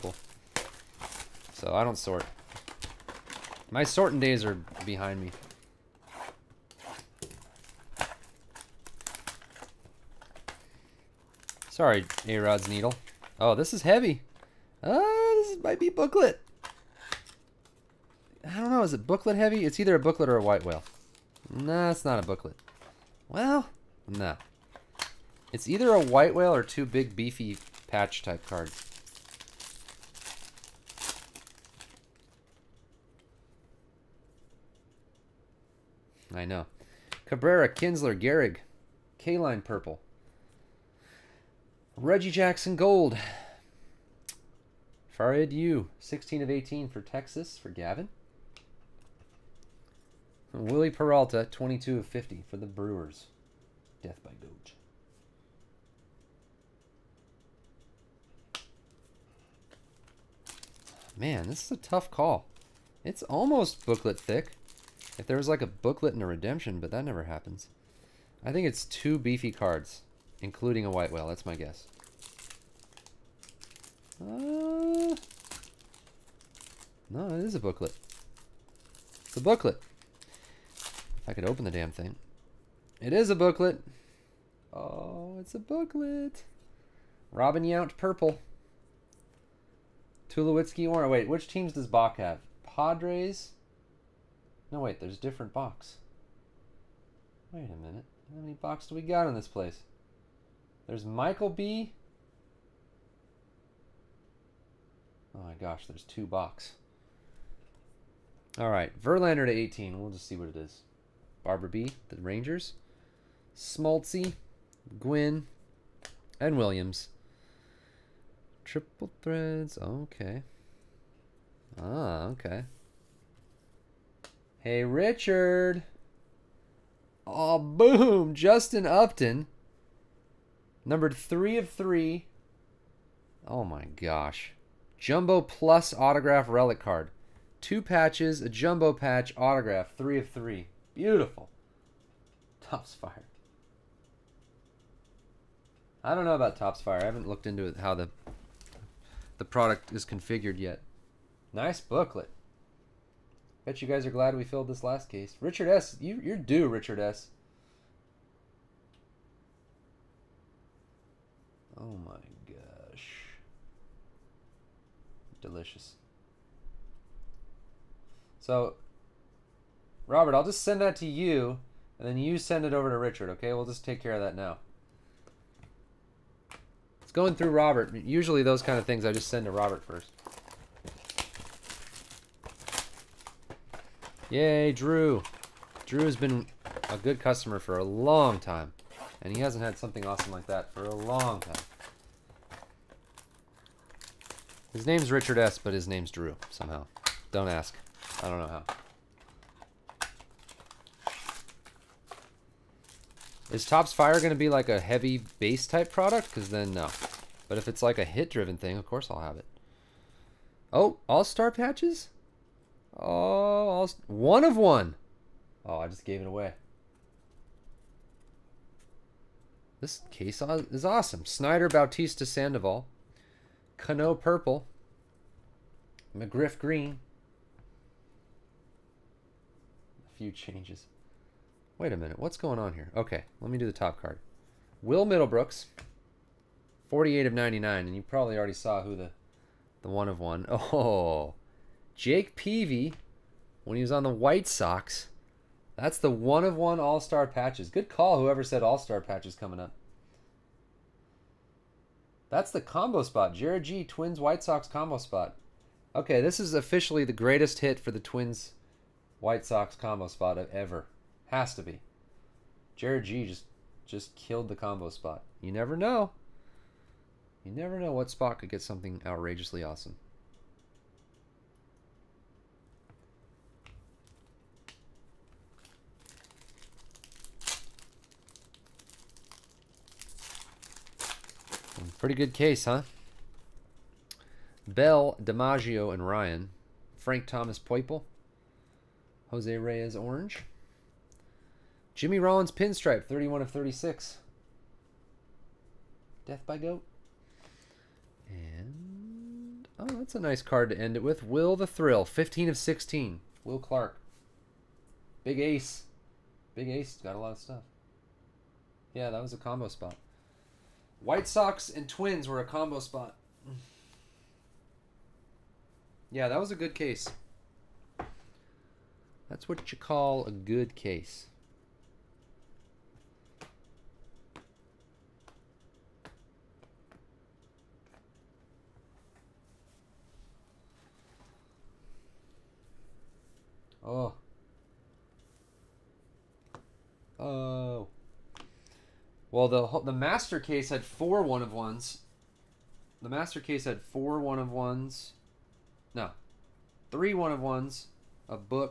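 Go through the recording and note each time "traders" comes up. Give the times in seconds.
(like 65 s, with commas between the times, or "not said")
not said.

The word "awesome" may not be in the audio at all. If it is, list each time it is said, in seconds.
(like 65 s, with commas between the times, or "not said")
190 s, 220 s, 269 s.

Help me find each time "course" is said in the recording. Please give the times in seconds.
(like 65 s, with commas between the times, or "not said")
208 s.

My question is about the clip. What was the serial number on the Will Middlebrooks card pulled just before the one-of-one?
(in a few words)
48 of 99.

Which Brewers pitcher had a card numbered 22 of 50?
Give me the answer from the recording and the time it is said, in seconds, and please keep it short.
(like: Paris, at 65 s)
Wily Peralta, at 50 s.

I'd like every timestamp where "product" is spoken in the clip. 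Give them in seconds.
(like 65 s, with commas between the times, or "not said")
149 s, 205 s.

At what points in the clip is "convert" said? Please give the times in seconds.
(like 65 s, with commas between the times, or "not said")
not said.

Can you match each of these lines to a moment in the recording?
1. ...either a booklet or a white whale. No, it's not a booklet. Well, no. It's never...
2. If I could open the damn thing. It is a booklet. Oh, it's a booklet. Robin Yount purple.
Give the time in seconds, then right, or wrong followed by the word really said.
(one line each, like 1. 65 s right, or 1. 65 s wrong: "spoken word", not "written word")
1. 19 s wrong: "either", not "never"
2. 81 s right.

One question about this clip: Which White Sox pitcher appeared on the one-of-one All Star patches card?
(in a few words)
Jake Peavy.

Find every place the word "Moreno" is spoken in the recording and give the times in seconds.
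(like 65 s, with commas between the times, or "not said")
not said.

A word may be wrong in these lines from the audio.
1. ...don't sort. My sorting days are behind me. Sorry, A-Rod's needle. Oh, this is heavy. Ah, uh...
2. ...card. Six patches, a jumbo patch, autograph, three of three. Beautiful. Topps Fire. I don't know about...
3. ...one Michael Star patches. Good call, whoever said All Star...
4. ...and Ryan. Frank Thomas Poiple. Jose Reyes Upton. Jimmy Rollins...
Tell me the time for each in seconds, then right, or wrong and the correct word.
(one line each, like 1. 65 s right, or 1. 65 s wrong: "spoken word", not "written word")
1. 1 s right
2. 136 s wrong: "Two", not "Six"
3. 246 s wrong: "All", not "Michael"
4. 285 s wrong: "Orange", not "Upton".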